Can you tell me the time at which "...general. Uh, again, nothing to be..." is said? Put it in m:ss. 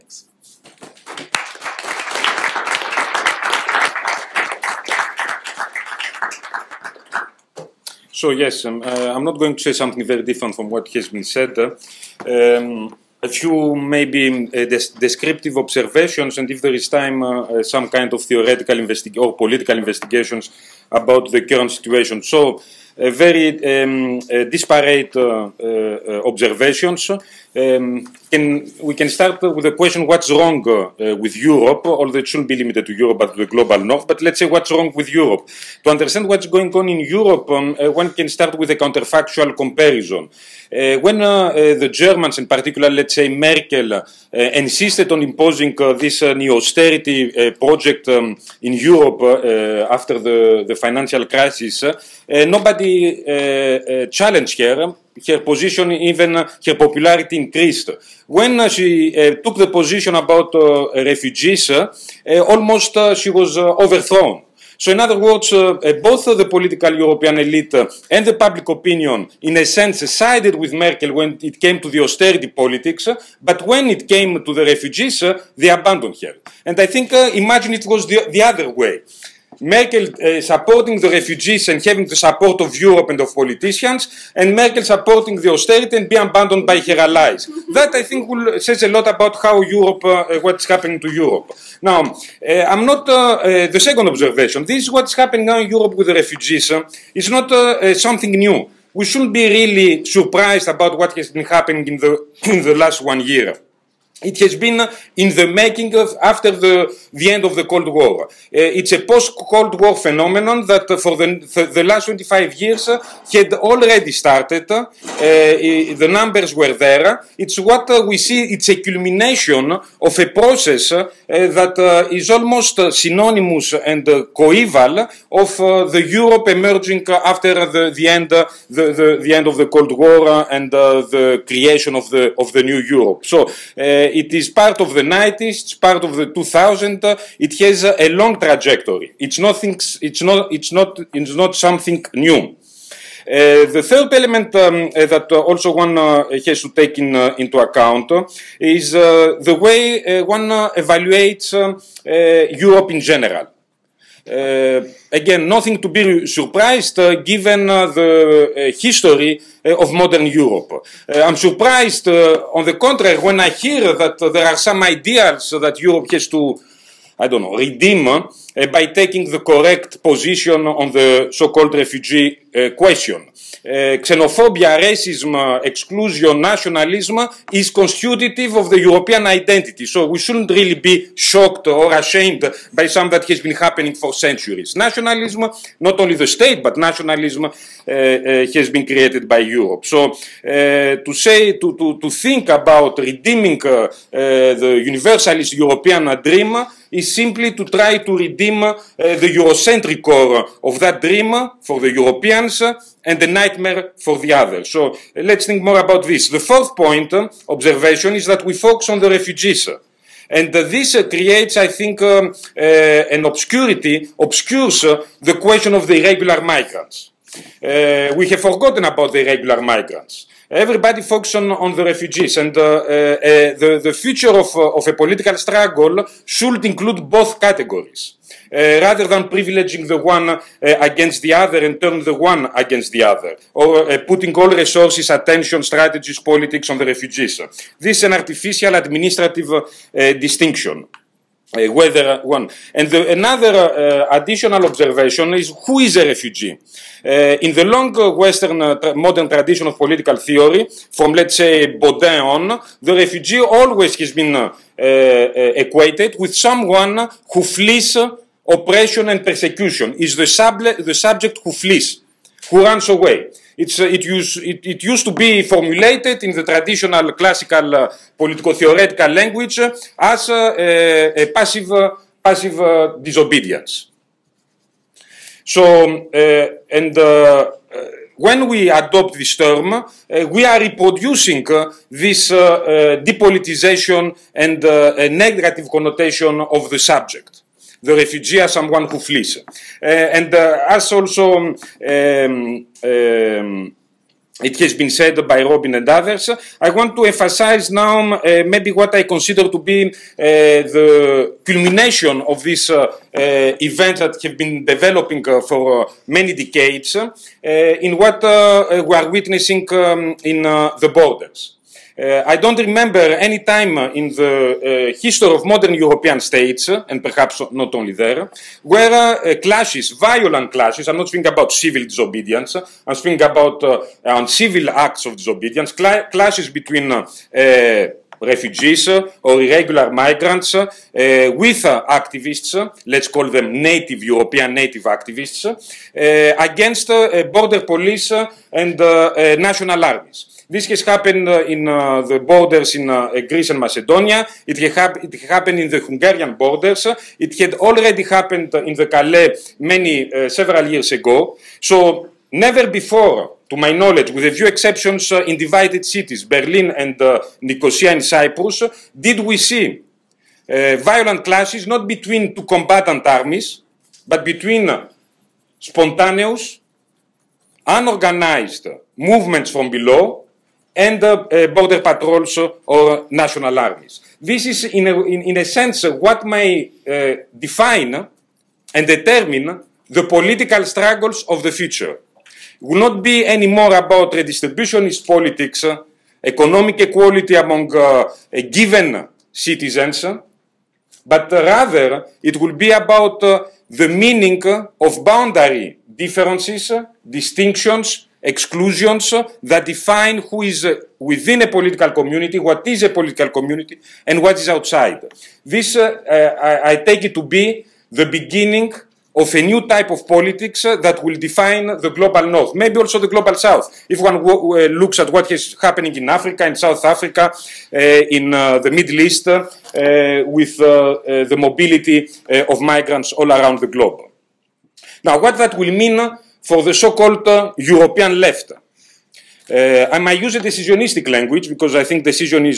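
2:33.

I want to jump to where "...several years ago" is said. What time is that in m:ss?
5:50.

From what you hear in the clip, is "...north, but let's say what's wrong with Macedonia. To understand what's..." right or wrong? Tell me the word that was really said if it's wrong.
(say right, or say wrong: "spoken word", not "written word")
wrong: "Europe", not "Macedonia".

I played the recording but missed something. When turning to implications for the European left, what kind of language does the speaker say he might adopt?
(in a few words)
Decisionistic.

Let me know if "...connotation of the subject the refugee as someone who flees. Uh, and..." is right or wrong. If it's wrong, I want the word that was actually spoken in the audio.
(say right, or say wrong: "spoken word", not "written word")
right.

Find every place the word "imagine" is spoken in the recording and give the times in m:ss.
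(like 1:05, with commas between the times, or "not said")
1:17.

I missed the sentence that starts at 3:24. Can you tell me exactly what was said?
So let's think more about this.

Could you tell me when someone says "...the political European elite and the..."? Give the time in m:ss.
1:06.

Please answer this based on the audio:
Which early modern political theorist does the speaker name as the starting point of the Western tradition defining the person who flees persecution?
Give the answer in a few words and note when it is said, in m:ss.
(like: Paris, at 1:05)
Bodin, at 4:11.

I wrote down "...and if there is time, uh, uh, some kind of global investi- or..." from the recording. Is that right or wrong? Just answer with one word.
wrong.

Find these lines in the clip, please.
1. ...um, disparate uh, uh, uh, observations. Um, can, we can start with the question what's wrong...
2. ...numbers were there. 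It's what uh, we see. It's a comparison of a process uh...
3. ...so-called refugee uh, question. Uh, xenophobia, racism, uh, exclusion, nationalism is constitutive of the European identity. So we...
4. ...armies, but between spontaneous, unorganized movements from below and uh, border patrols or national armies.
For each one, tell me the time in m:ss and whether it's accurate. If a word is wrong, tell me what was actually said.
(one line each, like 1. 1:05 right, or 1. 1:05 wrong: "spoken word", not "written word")
1. 0:23 right
2. 1:56 wrong: "culmination", not "comparison"
3. 2:51 right
4. 6:03 right.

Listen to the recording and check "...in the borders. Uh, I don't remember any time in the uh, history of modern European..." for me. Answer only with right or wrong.
right.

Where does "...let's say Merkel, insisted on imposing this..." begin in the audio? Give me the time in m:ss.
0:42.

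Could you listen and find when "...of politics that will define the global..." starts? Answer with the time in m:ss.
6:49.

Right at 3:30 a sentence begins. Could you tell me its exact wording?
And uh, this uh, creates, I think, um, uh, an obscurity, obscures uh, the question of the irregular migrants.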